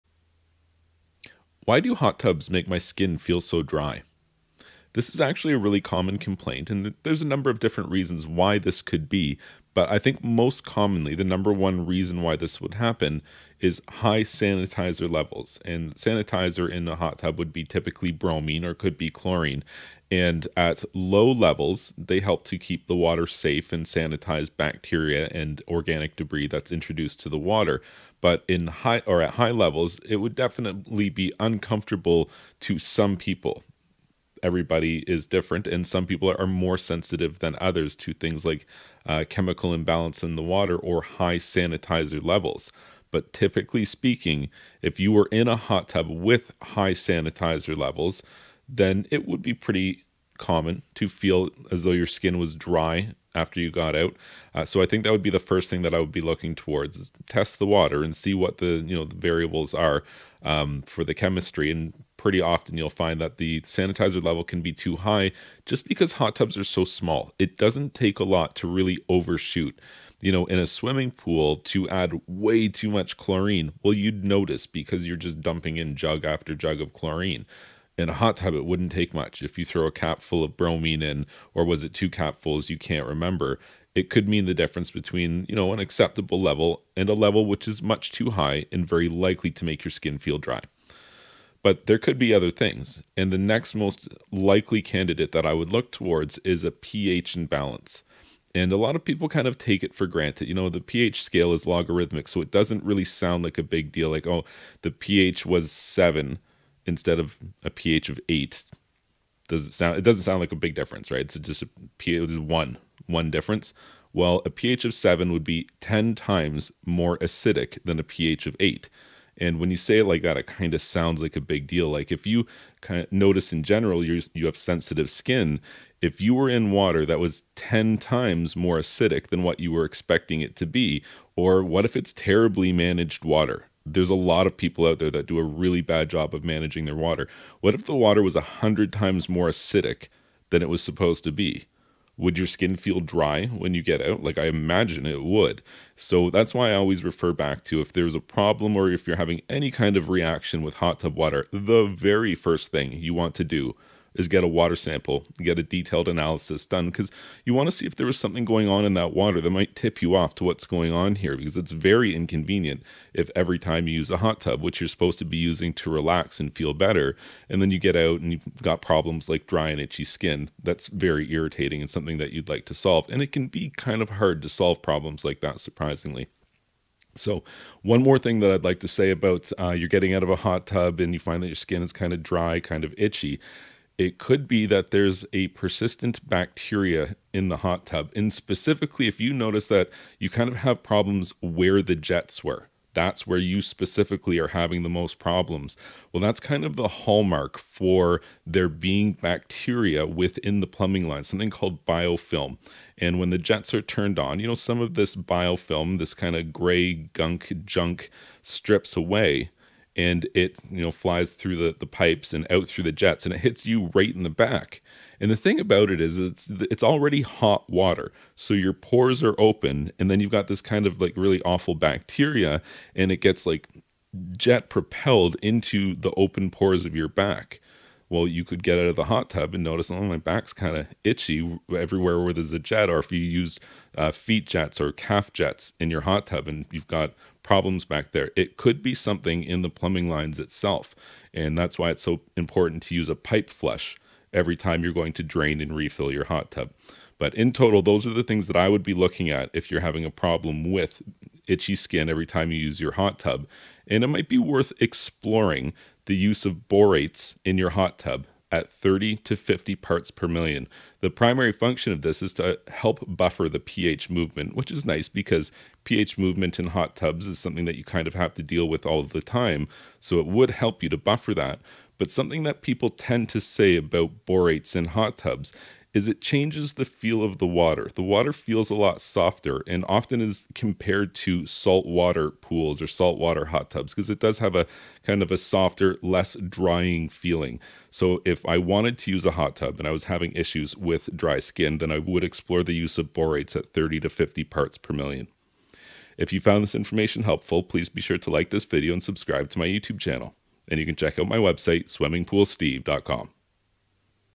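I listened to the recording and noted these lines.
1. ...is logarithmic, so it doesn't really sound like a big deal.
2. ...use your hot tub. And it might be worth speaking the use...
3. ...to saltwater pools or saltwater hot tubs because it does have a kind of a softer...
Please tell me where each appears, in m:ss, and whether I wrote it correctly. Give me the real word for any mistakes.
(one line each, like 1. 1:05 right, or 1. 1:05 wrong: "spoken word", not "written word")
1. 1:41 right
2. 4:12 wrong: "exploring", not "speaking"
3. 4:41 right.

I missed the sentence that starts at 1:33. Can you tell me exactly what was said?
And the next most likely candidate that I would look towards is a pH imbalance.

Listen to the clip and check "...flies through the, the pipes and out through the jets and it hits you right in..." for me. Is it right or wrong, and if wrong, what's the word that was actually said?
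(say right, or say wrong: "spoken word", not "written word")
right.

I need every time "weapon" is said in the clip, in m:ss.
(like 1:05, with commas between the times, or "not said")
not said.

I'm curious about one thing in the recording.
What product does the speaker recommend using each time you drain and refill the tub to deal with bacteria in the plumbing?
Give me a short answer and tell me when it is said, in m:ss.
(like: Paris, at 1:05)
Pipe flush, at 4:03.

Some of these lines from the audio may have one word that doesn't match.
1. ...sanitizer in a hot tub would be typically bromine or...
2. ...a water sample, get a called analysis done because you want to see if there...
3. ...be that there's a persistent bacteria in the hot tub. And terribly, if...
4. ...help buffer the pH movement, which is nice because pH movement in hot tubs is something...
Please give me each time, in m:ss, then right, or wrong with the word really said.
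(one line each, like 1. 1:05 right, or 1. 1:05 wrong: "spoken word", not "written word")
1. 0:15 right
2. 2:34 wrong: "detailed", not "called"
3. 3:04 wrong: "specifically", not "terribly"
4. 4:22 right.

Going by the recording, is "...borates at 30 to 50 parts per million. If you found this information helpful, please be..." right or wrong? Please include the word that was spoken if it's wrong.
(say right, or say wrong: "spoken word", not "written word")
right.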